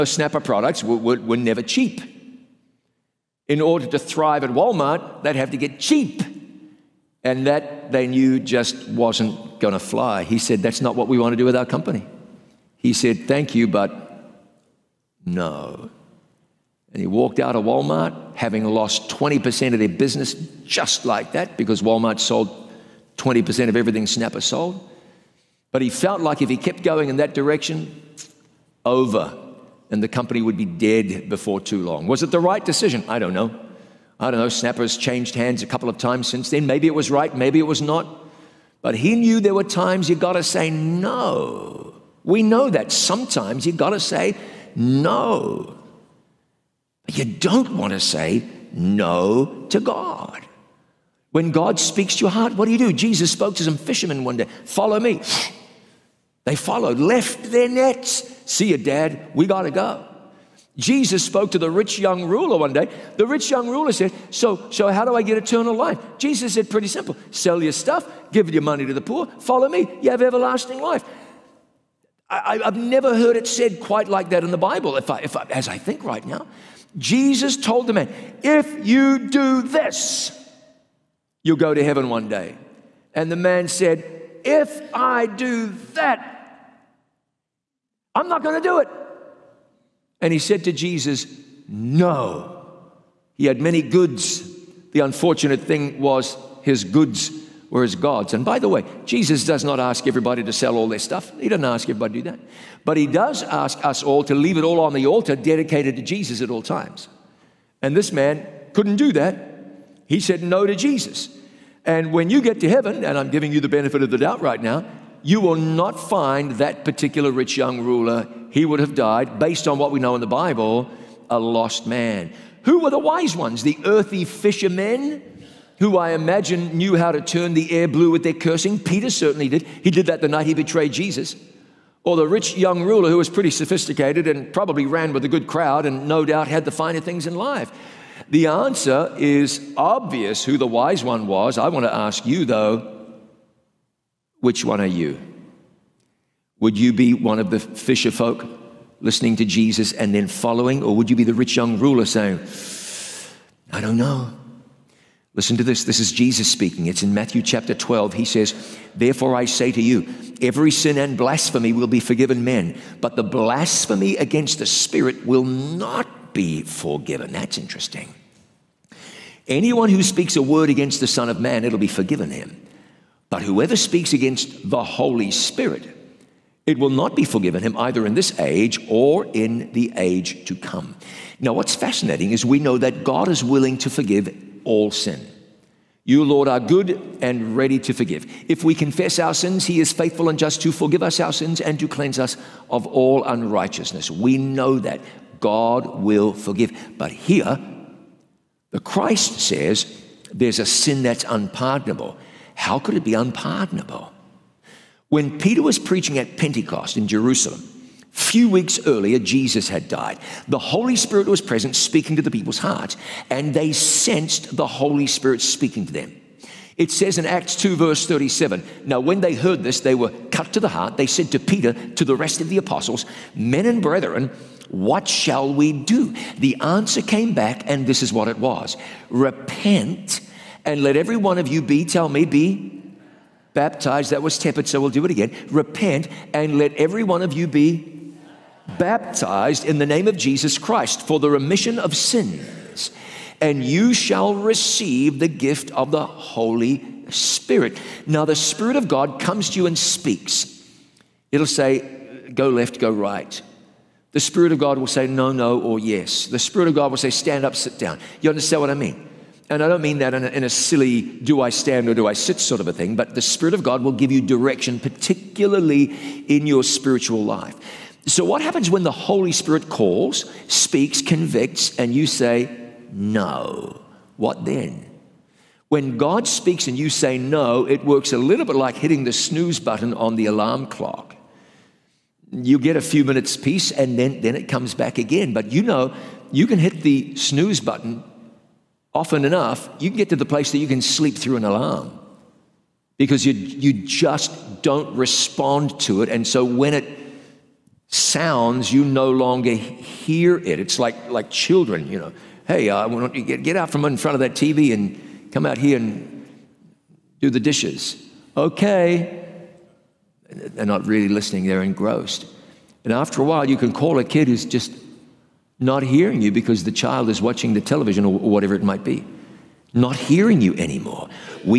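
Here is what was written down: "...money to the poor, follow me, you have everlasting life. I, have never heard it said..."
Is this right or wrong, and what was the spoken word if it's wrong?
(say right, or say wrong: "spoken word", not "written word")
right.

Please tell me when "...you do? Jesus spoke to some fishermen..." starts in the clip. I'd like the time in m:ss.
0:52.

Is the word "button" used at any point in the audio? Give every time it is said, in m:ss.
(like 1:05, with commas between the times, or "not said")
4:39, 4:47.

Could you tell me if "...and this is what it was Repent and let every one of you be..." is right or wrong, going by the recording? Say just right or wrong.
right.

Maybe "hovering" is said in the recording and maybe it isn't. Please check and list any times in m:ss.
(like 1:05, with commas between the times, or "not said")
not said.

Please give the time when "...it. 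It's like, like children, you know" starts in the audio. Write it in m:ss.
5:00.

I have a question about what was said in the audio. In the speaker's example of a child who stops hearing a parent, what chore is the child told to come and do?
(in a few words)
The dishes.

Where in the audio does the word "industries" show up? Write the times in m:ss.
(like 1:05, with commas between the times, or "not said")
not said.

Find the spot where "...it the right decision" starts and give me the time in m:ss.
0:32.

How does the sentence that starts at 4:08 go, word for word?
Now, the Spirit of God comes to you and speaks.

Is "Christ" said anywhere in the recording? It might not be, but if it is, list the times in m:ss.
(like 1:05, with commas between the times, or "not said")
3:18, 4:00.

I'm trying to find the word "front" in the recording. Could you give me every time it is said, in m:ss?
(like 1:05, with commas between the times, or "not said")
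5:03.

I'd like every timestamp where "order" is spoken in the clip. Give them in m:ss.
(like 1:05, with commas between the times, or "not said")
0:03.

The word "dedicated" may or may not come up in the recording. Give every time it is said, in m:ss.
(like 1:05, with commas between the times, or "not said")
1:45.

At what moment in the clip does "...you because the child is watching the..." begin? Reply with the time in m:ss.
5:16.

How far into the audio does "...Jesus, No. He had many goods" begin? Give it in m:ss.
1:30.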